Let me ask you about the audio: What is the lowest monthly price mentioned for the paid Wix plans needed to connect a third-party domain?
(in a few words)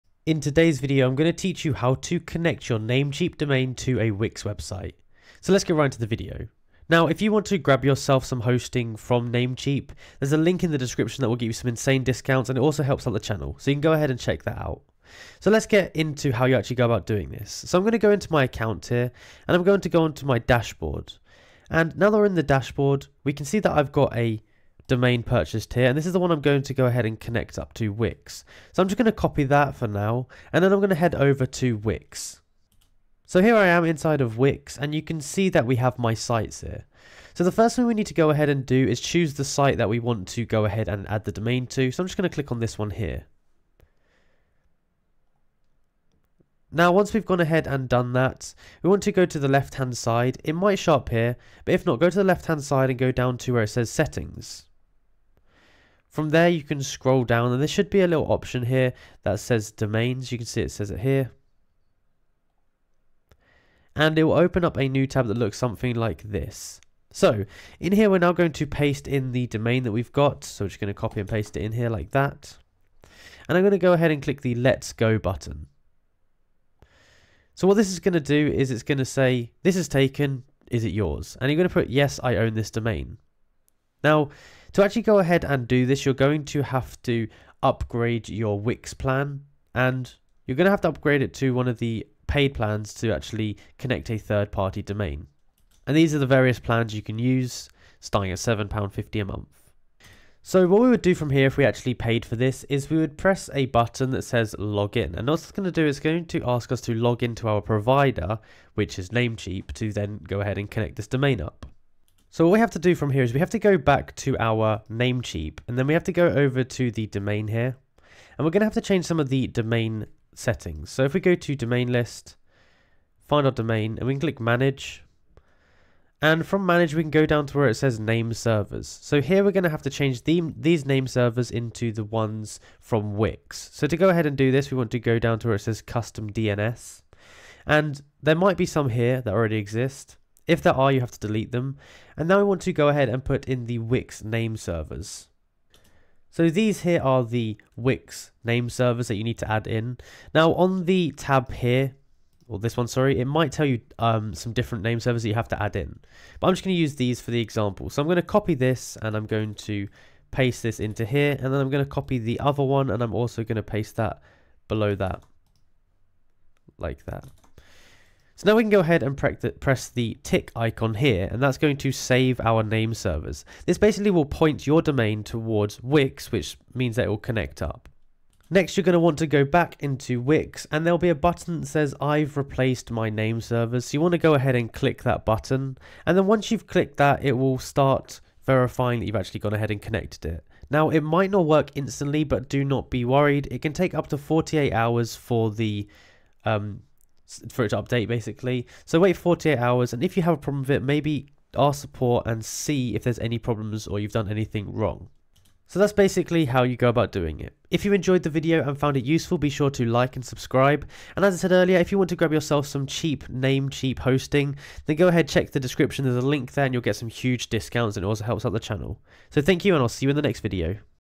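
£7.50.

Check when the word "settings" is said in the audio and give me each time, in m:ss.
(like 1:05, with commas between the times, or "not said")
0:53, 2:00.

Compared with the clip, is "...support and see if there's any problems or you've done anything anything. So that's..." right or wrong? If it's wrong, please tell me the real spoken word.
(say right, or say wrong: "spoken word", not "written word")
wrong: "wrong", not "anything".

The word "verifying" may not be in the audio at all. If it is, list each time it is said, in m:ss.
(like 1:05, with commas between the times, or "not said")
3:08.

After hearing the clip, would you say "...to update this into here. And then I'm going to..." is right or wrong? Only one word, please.
wrong.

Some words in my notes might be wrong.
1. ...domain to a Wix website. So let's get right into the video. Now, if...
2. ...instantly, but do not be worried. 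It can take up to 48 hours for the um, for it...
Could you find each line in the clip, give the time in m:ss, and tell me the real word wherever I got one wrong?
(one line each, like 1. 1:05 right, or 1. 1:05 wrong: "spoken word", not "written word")
1. 0:03 right
2. 3:11 right.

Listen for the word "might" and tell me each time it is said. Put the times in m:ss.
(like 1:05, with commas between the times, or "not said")
0:50, 2:18, 2:33, 3:11.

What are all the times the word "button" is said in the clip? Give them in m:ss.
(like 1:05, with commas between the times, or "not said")
1:15, 1:43, 3:01, 3:05.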